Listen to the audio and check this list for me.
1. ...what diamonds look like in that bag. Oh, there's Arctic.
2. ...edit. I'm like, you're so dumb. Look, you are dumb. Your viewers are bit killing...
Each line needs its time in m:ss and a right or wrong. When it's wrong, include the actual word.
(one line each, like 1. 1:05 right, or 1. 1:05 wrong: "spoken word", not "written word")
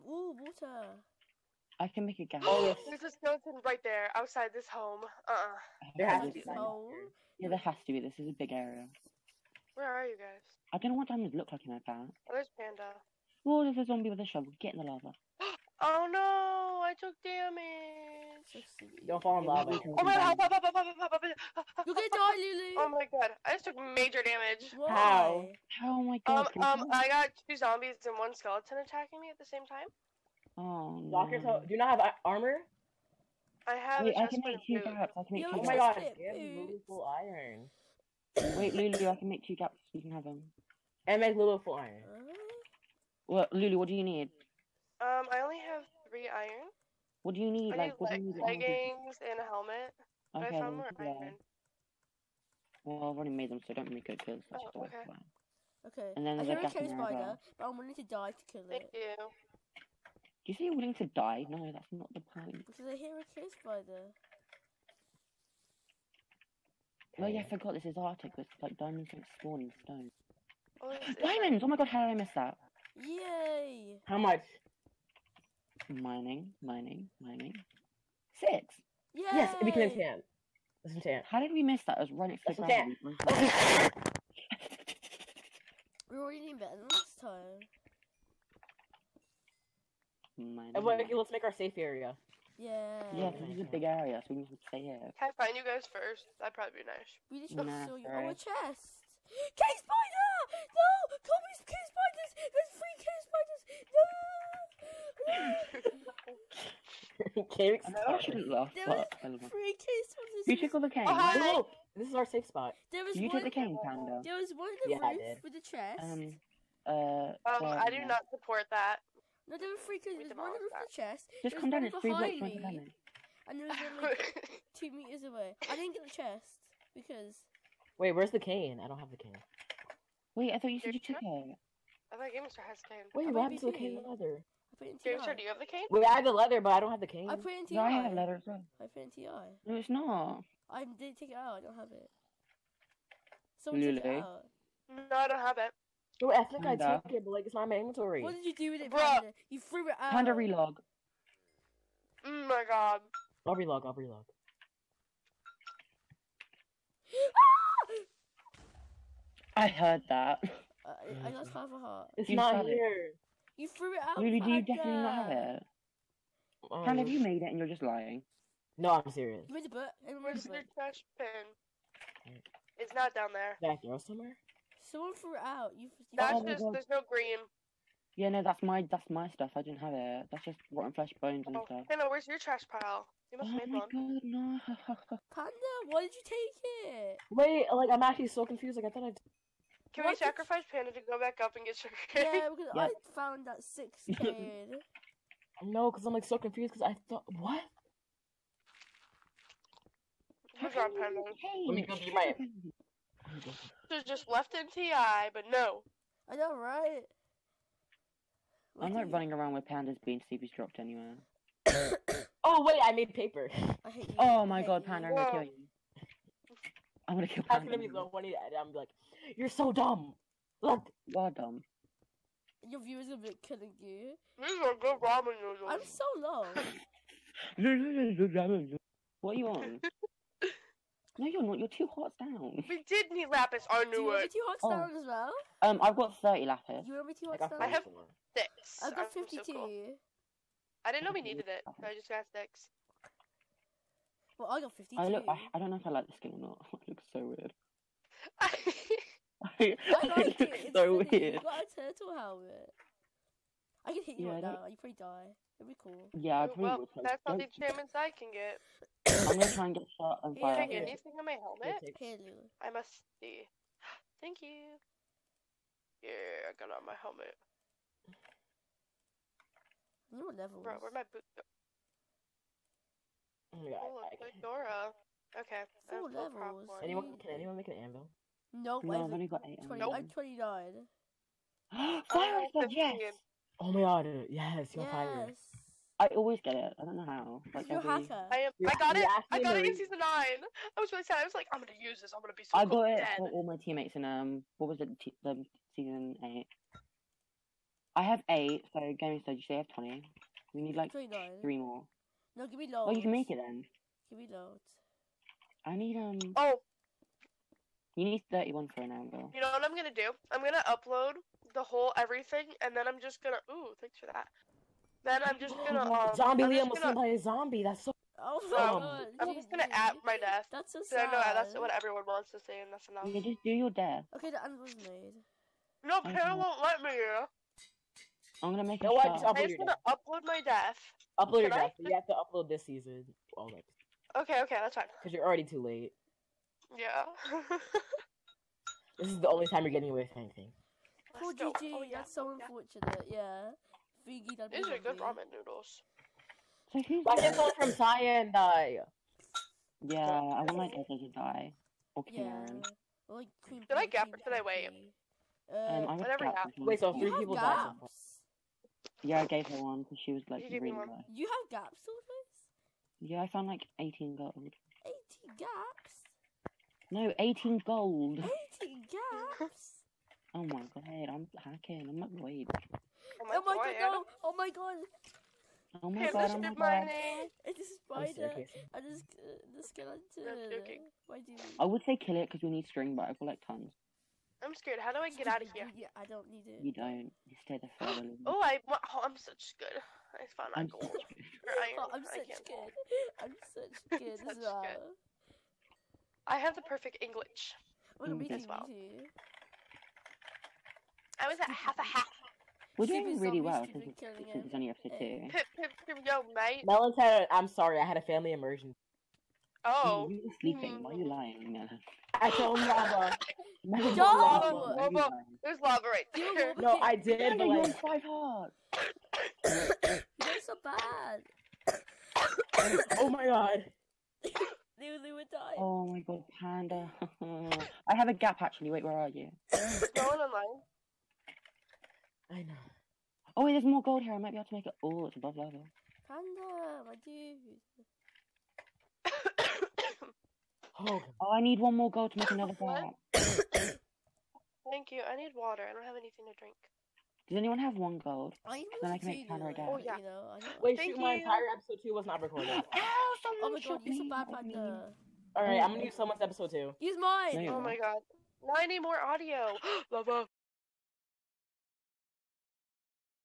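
1. 0:11 wrong: "Panda", not "Arctic"
2. 3:38 right.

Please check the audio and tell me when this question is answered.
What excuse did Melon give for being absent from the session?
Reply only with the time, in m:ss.
6:48.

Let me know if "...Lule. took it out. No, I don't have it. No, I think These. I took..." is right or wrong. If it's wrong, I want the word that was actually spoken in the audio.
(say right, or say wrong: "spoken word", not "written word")
wrong: "Panda", not "These".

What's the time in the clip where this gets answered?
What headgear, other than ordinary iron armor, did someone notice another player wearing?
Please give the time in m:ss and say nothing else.
4:11.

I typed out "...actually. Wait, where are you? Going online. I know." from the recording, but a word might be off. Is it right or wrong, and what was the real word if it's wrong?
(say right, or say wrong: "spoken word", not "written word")
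right.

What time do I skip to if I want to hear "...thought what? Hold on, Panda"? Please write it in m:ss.
3:17.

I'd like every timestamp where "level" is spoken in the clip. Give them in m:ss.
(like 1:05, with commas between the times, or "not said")
4:30, 4:36, 7:15.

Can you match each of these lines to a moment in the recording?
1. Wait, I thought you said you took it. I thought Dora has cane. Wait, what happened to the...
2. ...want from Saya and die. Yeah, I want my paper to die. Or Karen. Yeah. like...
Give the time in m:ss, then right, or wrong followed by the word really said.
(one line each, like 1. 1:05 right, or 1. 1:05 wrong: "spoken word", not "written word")
1. 2:10 wrong: "Gamestar", not "Dora"
2. 5:47 wrong: "daughter", not "paper".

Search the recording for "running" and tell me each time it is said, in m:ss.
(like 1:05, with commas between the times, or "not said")
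1:22, 3:29.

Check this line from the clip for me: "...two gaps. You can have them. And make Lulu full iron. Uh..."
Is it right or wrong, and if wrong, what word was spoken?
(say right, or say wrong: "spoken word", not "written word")
right.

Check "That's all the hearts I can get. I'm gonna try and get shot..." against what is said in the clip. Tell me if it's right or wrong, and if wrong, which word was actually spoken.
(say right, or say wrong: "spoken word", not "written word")
wrong: "achievements", not "hearts".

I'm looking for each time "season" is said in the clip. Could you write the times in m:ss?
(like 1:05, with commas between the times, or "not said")
4:49, 4:55, 5:32.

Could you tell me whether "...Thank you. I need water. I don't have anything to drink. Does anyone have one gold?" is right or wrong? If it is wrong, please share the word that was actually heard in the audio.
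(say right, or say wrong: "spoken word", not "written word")
right.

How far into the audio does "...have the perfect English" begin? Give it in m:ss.
6:36.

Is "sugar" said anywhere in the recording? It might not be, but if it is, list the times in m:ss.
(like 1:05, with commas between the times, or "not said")
3:11.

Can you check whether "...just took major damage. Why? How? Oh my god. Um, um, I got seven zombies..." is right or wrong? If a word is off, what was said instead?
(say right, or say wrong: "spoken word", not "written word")
wrong: "two", not "seven".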